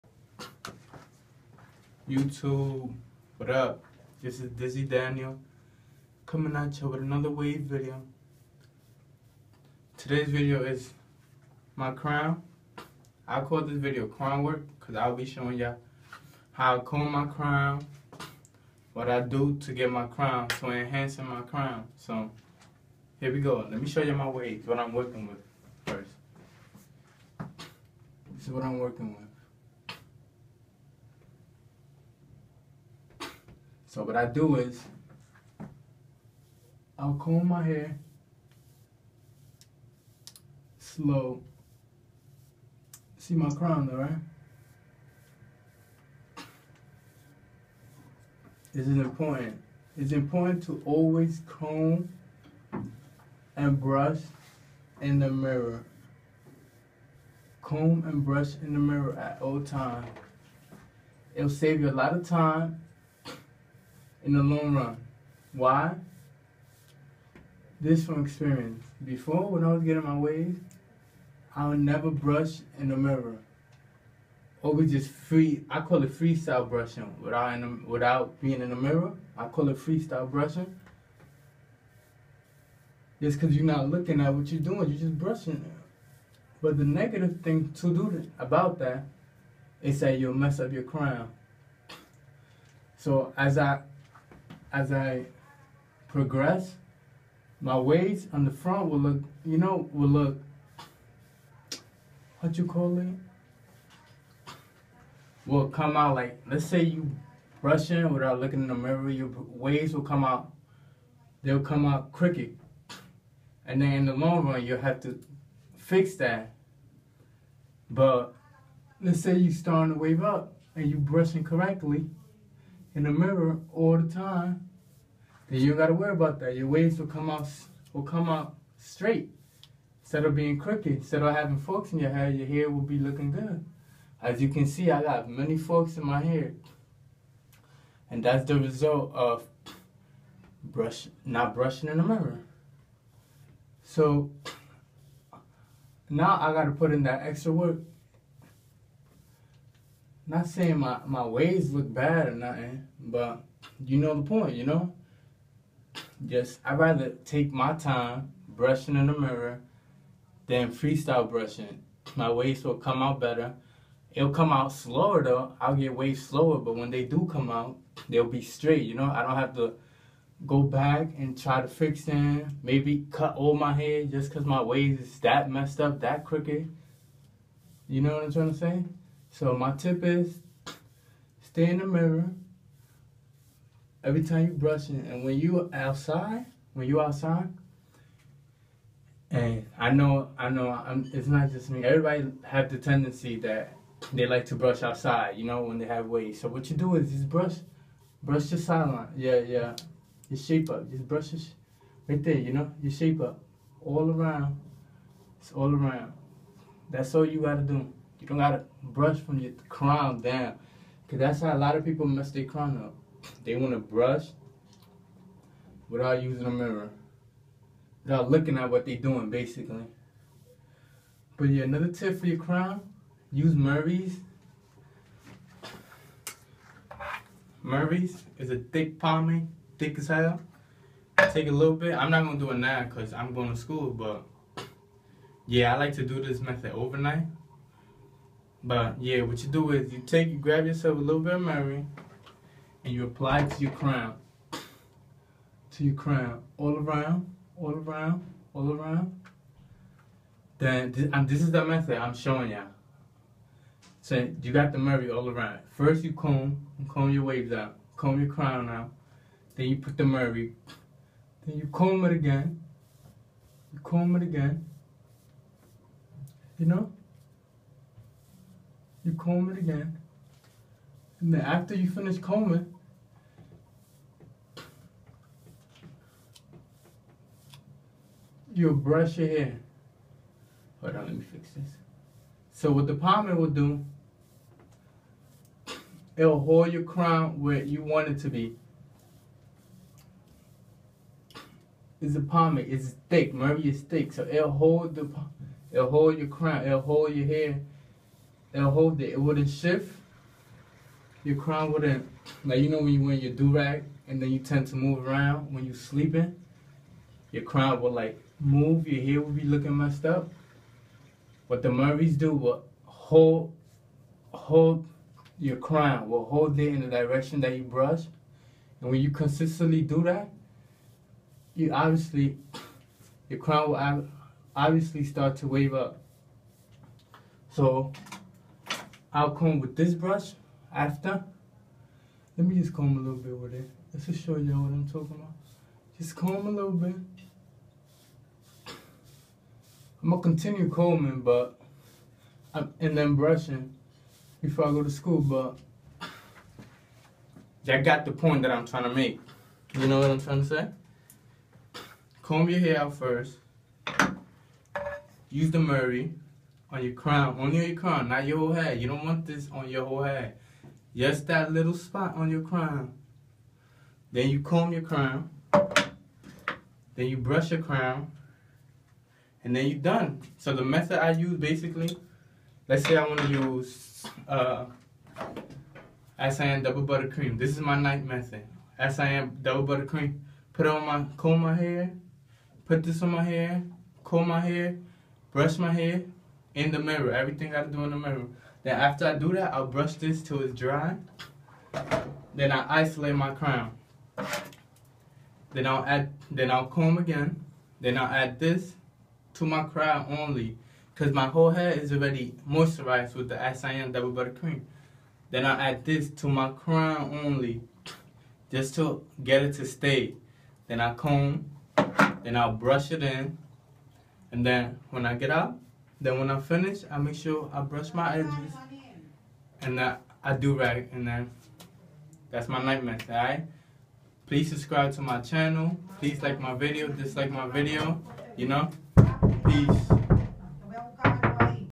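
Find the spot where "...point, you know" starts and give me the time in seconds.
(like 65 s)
154 s.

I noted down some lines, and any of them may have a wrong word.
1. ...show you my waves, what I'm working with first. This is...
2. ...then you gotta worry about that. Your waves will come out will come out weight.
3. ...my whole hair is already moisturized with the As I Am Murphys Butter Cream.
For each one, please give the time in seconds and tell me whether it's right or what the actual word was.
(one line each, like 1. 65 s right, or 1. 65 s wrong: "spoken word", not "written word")
1. 23 s right
2. 125 s wrong: "straight", not "weight"
3. 401 s wrong: "Double", not "Murphys".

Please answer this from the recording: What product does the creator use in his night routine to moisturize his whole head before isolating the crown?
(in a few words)
As I Am Double Butter Cream.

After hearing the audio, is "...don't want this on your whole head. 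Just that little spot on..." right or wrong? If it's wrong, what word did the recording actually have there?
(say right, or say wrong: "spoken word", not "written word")
right.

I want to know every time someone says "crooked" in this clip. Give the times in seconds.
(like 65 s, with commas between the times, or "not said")
112 s, 130 s, 176 s.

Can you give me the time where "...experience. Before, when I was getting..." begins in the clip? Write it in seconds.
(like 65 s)
68 s.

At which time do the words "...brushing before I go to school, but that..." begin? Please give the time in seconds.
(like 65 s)
343 s.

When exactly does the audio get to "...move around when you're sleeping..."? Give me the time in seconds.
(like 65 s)
304 s.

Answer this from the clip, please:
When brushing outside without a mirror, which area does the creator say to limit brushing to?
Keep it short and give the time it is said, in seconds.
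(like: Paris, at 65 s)
Sideline, at 198 s.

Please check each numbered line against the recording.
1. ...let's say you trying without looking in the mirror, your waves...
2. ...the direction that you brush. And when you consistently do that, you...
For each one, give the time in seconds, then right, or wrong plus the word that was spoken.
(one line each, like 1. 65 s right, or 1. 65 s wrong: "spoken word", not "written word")
1. 106 s wrong: "brushing", not "trying"
2. 316 s right.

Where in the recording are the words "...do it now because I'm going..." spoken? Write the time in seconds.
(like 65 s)
232 s.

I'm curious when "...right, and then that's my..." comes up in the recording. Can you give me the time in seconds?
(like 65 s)
420 s.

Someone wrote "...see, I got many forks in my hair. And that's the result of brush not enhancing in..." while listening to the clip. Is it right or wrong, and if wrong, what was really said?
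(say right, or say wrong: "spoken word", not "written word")
wrong: "brushing", not "enhancing".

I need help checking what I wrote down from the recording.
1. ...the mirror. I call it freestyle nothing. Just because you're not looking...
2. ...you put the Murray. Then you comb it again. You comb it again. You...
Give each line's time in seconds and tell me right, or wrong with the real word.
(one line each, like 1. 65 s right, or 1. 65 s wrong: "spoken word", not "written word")
1. 78 s wrong: "brushing", not "nothing"
2. 259 s right.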